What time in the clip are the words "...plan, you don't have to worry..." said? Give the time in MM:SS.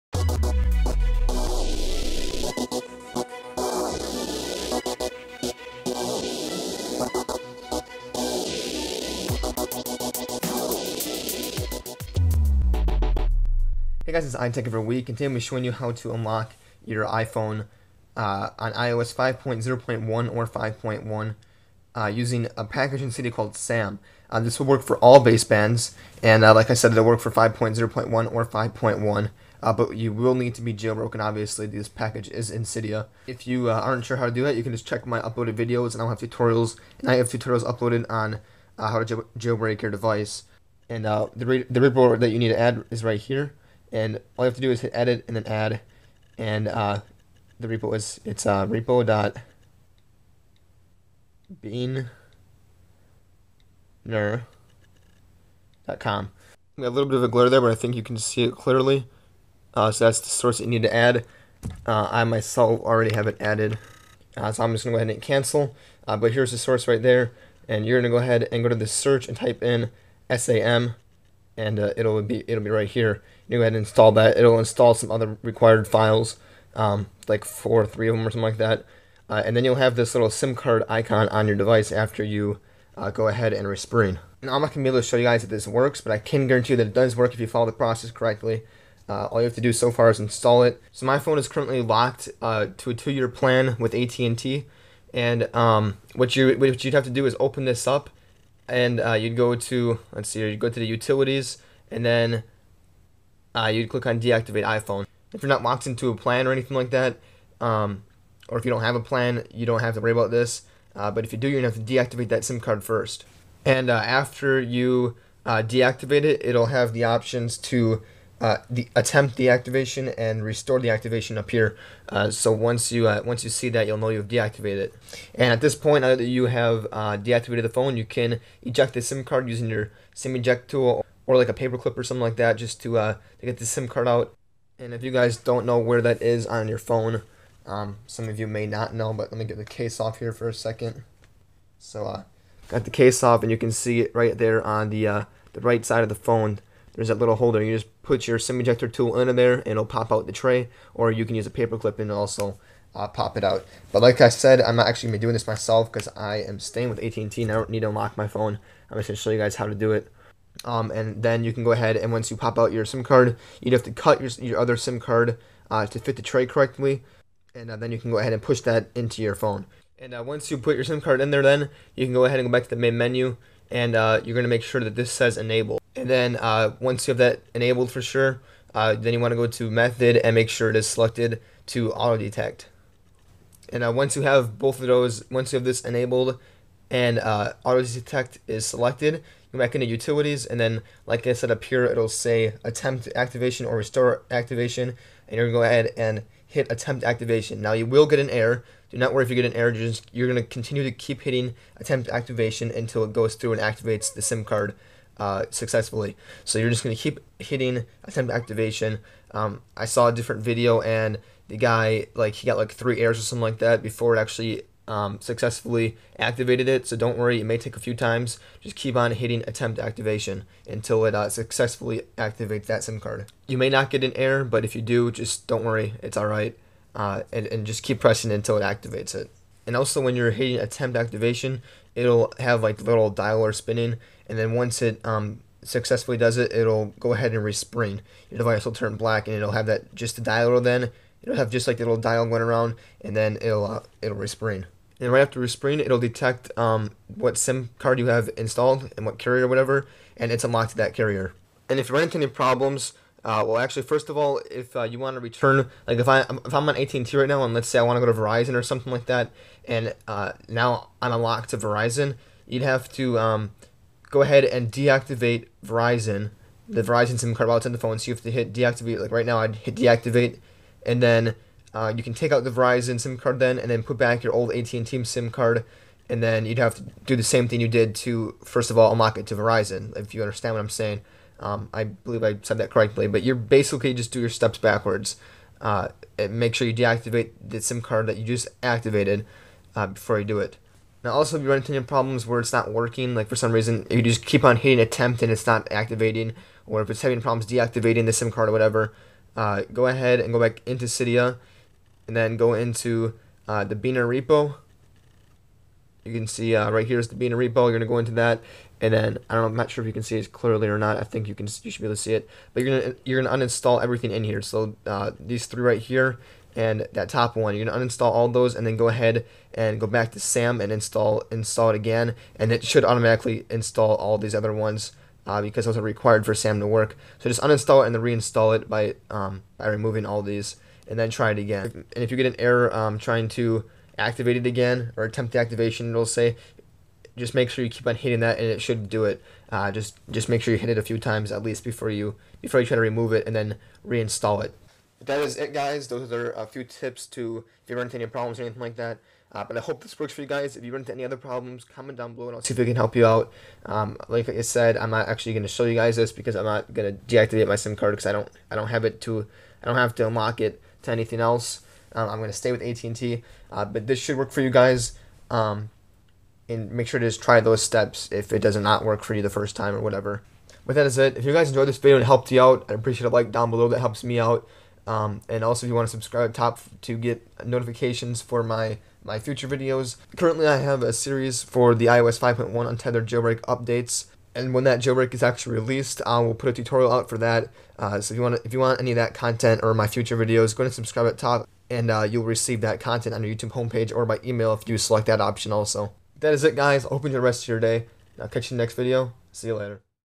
01:49.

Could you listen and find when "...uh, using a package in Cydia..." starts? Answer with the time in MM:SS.
00:21.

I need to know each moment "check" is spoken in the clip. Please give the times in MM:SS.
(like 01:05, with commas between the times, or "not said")
00:34.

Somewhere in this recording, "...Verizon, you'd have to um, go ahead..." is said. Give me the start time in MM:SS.
04:21.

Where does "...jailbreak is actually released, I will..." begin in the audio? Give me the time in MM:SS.
06:24.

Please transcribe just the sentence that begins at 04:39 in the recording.
If you understand what I'm saying.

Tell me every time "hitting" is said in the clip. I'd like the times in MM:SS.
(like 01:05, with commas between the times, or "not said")
03:21, 03:27, 03:39, 03:50, 04:54, 05:37.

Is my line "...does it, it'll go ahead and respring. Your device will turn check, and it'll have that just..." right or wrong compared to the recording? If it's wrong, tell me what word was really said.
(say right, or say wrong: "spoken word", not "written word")
wrong: "black", not "check".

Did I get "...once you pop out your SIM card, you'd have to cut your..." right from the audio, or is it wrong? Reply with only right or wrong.
right.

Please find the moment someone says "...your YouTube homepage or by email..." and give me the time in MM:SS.
06:33.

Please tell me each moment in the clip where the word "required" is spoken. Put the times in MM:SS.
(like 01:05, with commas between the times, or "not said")
01:15, 05:25.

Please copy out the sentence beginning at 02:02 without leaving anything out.
Uh, so once you uh, once you see that, you'll know you've deactivated it.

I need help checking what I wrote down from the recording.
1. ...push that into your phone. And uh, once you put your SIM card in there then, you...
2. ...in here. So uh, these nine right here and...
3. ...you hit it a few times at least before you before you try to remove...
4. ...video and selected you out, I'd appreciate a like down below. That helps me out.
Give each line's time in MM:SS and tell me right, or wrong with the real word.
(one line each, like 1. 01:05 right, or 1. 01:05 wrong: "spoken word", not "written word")
1. 02:48 right
2. 05:14 wrong: "three", not "nine"
3. 05:40 right
4. 06:11 wrong: "helped", not "selected".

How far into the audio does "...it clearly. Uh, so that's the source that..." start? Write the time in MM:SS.
00:58.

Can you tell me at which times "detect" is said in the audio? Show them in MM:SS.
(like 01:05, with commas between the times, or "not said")
03:02, 03:07, 04:05.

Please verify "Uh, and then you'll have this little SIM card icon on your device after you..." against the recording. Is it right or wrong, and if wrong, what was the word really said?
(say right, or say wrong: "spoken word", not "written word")
right.